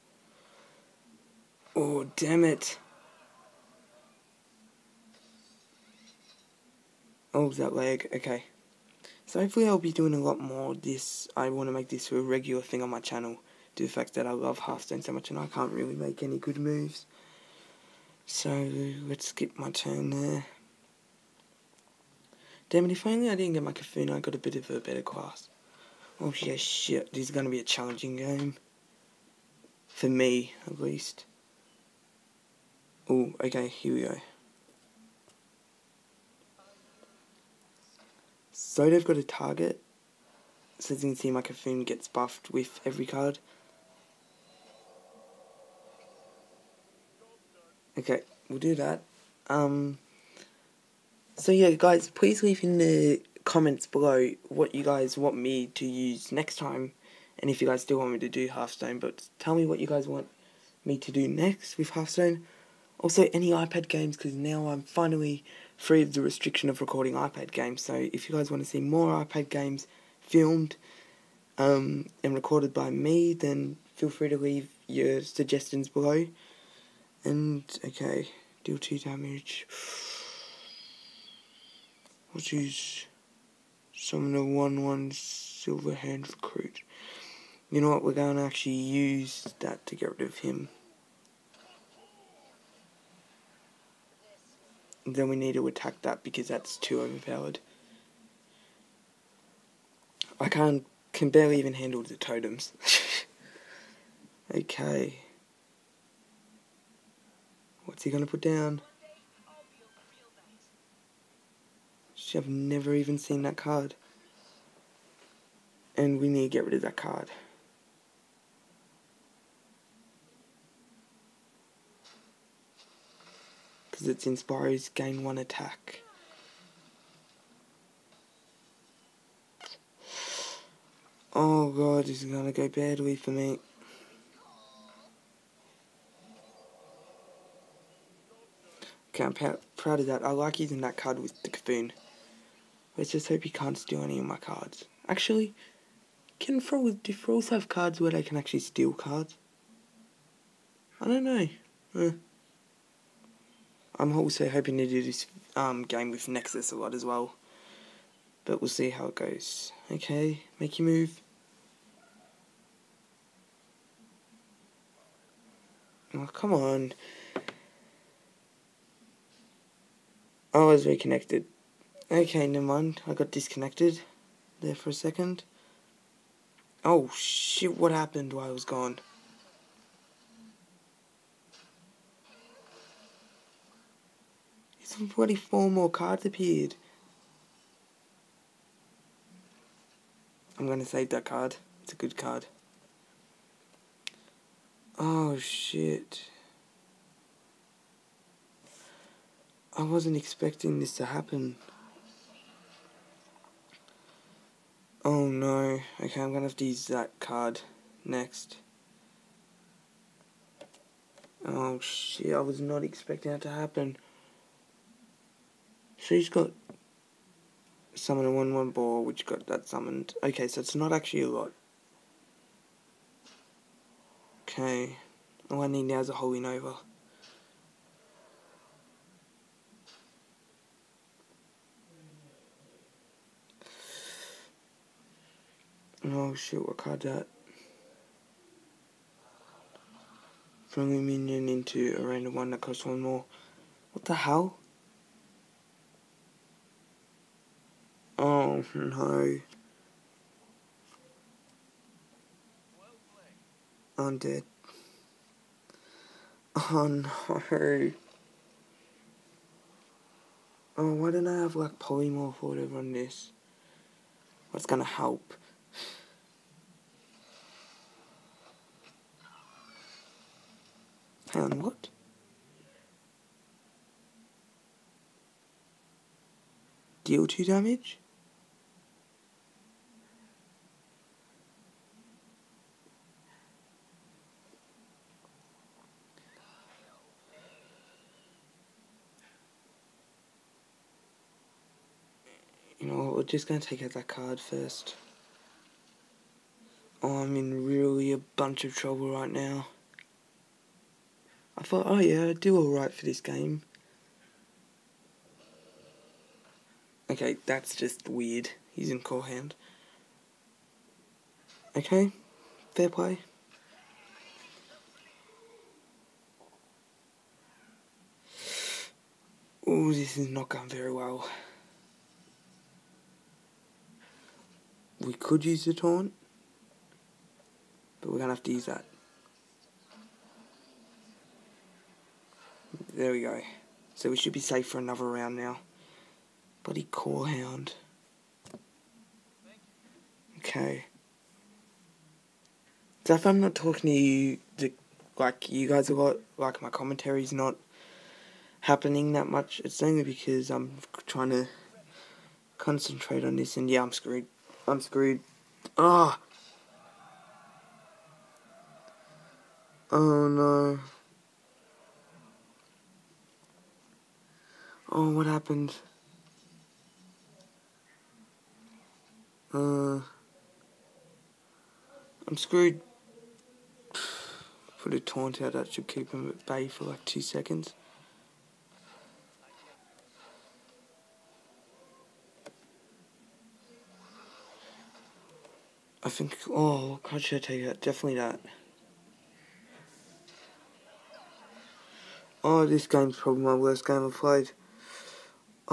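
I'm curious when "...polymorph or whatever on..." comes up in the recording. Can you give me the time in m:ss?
4:21.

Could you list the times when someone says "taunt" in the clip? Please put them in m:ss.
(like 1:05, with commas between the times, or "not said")
5:25, 6:15.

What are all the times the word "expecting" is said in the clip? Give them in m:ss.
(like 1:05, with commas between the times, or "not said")
3:20, 3:32.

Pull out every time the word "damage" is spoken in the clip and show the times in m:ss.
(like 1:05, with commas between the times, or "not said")
1:18, 4:37.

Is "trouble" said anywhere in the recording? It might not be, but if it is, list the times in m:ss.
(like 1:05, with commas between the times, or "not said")
4:58.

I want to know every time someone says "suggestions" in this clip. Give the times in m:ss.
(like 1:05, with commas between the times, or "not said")
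1:15.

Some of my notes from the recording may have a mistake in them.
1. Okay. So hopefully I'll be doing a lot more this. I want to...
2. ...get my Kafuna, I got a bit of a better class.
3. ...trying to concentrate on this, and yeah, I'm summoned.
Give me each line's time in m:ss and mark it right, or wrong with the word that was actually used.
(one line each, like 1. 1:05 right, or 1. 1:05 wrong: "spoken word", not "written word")
1. 0:08 right
2. 0:23 right
3. 5:51 wrong: "screwed", not "summoned".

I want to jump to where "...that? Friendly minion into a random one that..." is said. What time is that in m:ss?
3:57.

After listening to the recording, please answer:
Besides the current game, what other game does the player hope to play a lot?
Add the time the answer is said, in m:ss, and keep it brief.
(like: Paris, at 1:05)
Nexus, at 2:36.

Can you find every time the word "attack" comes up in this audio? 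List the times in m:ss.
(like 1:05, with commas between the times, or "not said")
1:35, 2:05.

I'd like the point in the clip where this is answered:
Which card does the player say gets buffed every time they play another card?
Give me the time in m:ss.
0:41.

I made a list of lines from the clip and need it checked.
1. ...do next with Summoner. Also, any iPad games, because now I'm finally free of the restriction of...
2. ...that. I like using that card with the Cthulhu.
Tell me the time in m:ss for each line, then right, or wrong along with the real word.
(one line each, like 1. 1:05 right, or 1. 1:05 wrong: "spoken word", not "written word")
1. 1:01 wrong: "Hearthstone", not "Summoner"
2. 2:20 right.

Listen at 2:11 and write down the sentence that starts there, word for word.
Oh god, this is gonna go badly for me.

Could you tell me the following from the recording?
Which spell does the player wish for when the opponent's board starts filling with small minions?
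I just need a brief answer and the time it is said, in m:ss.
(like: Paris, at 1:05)
Holy Nova, at 3:46.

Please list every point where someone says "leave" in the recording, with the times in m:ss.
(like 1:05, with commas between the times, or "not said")
0:52, 1:14.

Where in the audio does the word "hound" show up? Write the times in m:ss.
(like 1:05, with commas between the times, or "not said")
5:09, 5:37.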